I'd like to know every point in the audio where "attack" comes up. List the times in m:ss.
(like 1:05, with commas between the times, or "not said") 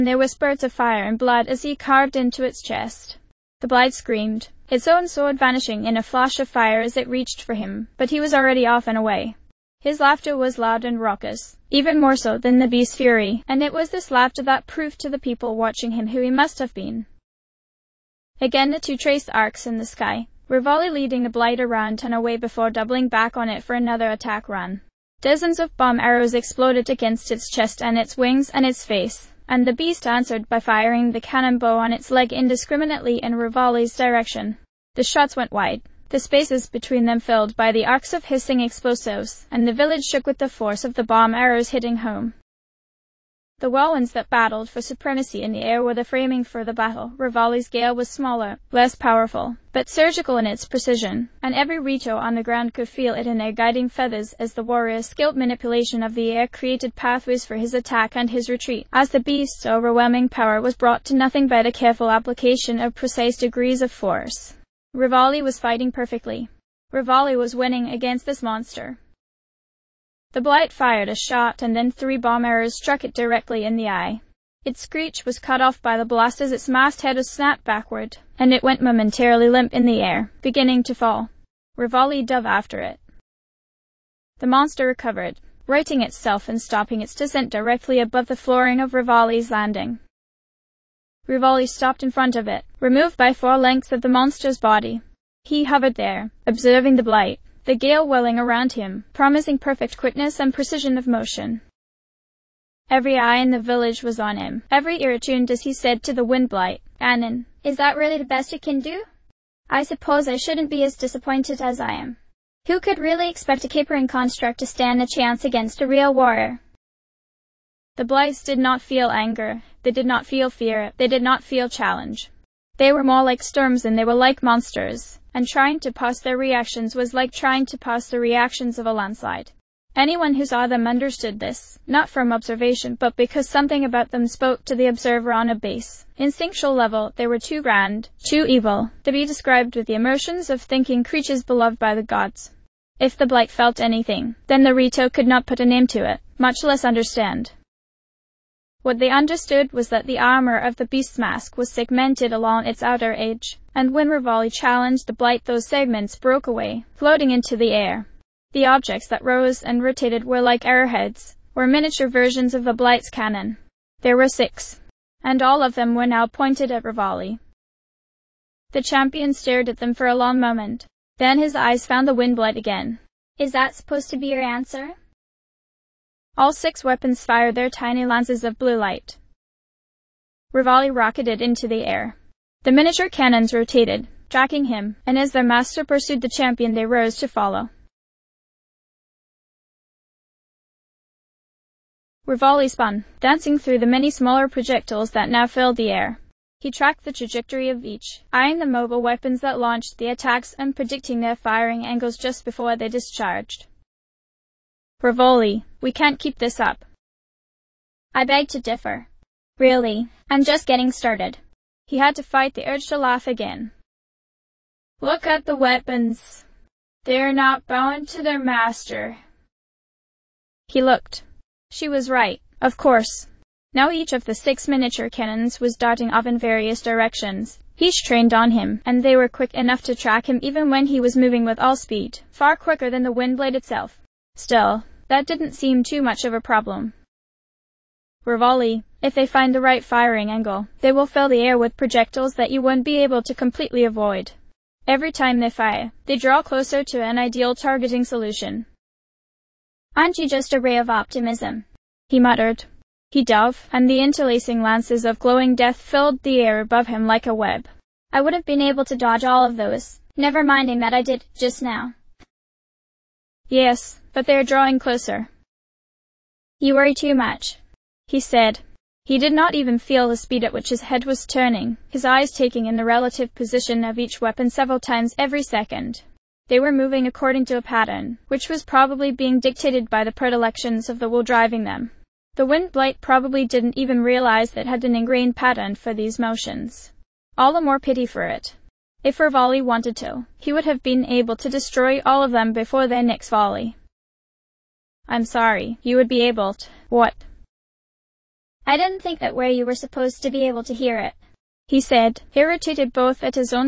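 0:24, 0:57, 3:20.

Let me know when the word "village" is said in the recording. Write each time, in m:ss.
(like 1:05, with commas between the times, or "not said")
0:39, 1:43.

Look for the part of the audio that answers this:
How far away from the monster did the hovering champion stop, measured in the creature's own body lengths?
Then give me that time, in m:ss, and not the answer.
1:33.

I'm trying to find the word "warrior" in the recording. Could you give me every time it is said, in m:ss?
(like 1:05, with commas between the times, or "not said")
0:54, 1:56.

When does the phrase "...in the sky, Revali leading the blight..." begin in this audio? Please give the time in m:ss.
0:19.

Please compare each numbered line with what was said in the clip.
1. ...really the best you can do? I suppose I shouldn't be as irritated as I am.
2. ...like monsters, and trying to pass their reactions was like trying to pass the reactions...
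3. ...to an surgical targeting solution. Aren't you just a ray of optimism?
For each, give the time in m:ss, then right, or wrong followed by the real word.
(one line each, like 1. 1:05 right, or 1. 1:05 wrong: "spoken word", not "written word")
1. 1:47 wrong: "disappointed", not "irritated"
2. 2:04 right
3. 4:06 wrong: "ideal", not "surgical".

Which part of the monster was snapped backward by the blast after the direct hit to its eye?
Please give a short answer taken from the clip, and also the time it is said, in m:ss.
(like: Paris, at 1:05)
masthead, at 1:16.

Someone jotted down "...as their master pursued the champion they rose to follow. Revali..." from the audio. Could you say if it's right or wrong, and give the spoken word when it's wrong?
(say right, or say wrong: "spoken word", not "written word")
right.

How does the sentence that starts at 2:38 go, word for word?
The objects that rose and rotated were like arrowheads, or miniature versions of the blight's cannon.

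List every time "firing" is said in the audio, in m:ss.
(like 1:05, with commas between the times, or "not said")
0:30, 3:21, 3:59.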